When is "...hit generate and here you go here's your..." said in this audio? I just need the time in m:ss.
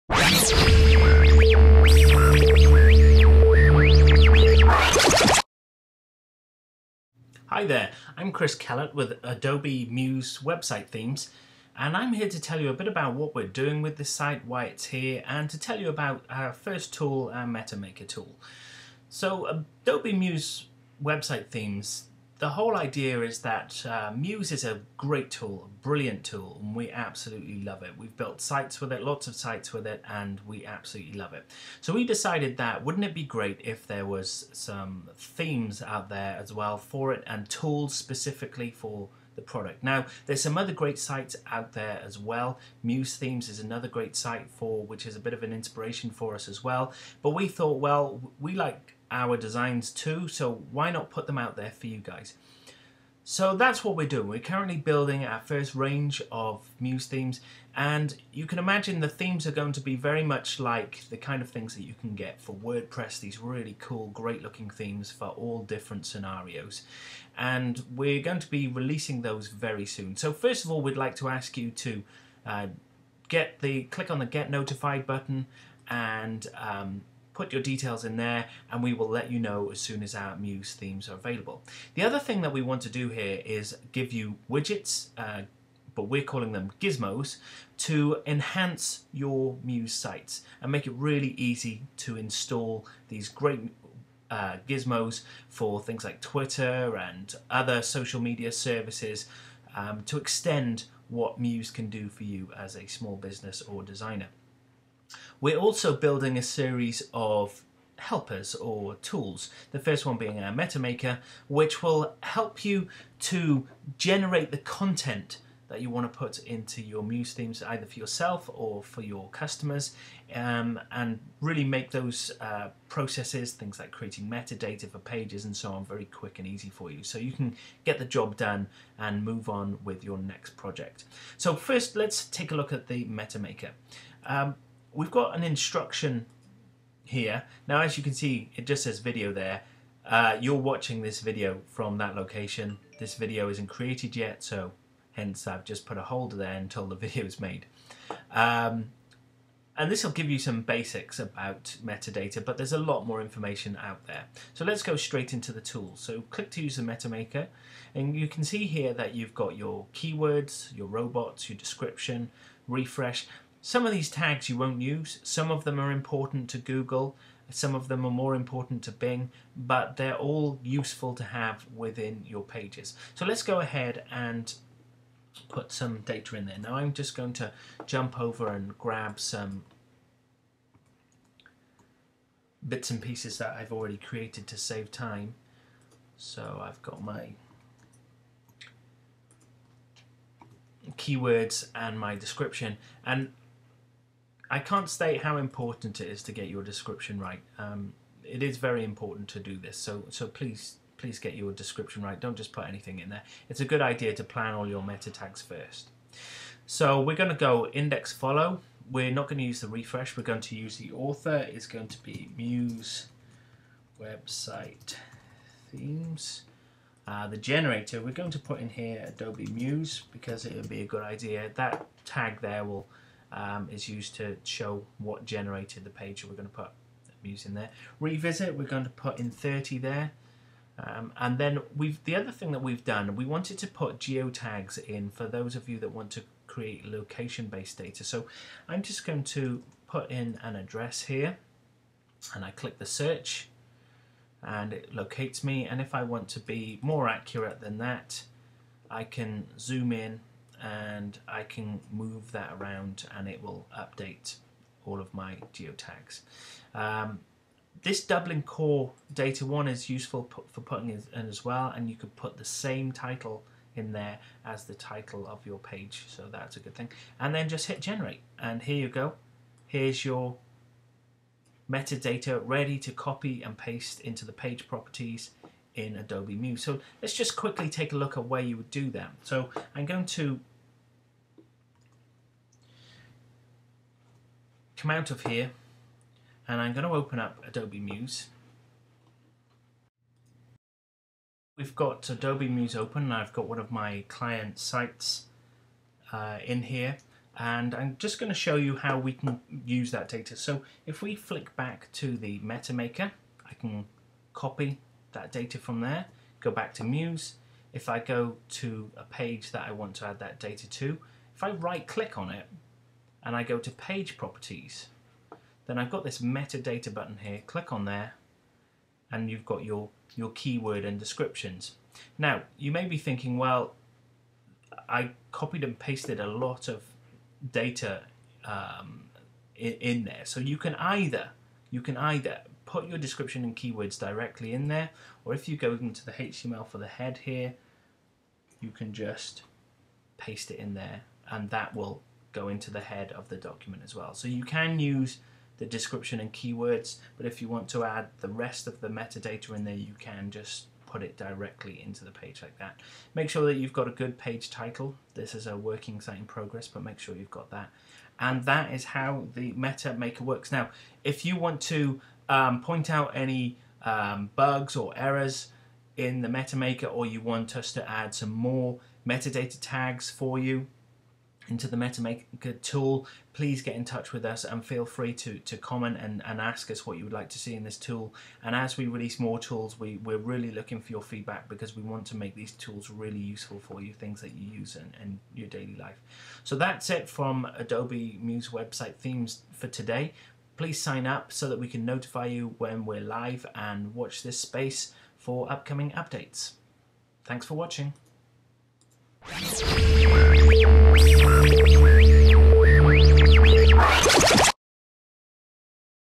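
4:27.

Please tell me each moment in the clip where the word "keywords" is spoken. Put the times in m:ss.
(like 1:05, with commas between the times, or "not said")
2:39, 3:10, 5:20, 5:33, 5:46.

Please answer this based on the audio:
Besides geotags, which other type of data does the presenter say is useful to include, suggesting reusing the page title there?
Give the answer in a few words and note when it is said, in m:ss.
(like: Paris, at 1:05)
Dublin core, at 4:18.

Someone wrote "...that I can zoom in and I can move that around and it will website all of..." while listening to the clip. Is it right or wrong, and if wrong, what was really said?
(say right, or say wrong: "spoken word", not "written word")
wrong: "update", not "website".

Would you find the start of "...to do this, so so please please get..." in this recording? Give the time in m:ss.
3:19.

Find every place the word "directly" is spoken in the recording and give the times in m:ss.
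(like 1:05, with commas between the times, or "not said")
5:33, 5:51.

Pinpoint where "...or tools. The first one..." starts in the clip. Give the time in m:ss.
1:48.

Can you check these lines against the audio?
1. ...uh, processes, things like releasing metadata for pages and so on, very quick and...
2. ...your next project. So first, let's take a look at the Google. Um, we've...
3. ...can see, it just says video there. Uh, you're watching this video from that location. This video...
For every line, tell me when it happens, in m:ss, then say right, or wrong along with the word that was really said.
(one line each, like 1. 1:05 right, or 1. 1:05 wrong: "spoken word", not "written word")
1. 2:02 wrong: "creating", not "releasing"
2. 2:10 wrong: "MetaMaker", not "Google"
3. 2:18 right.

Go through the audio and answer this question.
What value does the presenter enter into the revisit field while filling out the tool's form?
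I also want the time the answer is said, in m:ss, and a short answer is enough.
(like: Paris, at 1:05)
30, at 3:49.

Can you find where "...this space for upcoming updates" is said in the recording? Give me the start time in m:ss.
6:34.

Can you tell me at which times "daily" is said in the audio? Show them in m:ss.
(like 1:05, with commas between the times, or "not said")
6:25.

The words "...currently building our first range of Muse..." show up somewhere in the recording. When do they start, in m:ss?
0:54.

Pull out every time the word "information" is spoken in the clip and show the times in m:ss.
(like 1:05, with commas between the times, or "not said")
2:33.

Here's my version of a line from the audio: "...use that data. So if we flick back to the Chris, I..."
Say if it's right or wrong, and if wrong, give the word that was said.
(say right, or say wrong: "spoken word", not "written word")
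wrong: "MetaMaker", not "Chris".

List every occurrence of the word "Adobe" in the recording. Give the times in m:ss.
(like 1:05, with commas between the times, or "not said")
0:09, 0:19, 3:39, 4:35, 4:47, 4:52, 6:27.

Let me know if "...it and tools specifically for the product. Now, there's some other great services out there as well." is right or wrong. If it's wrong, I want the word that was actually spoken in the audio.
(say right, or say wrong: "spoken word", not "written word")
wrong: "sites", not "services".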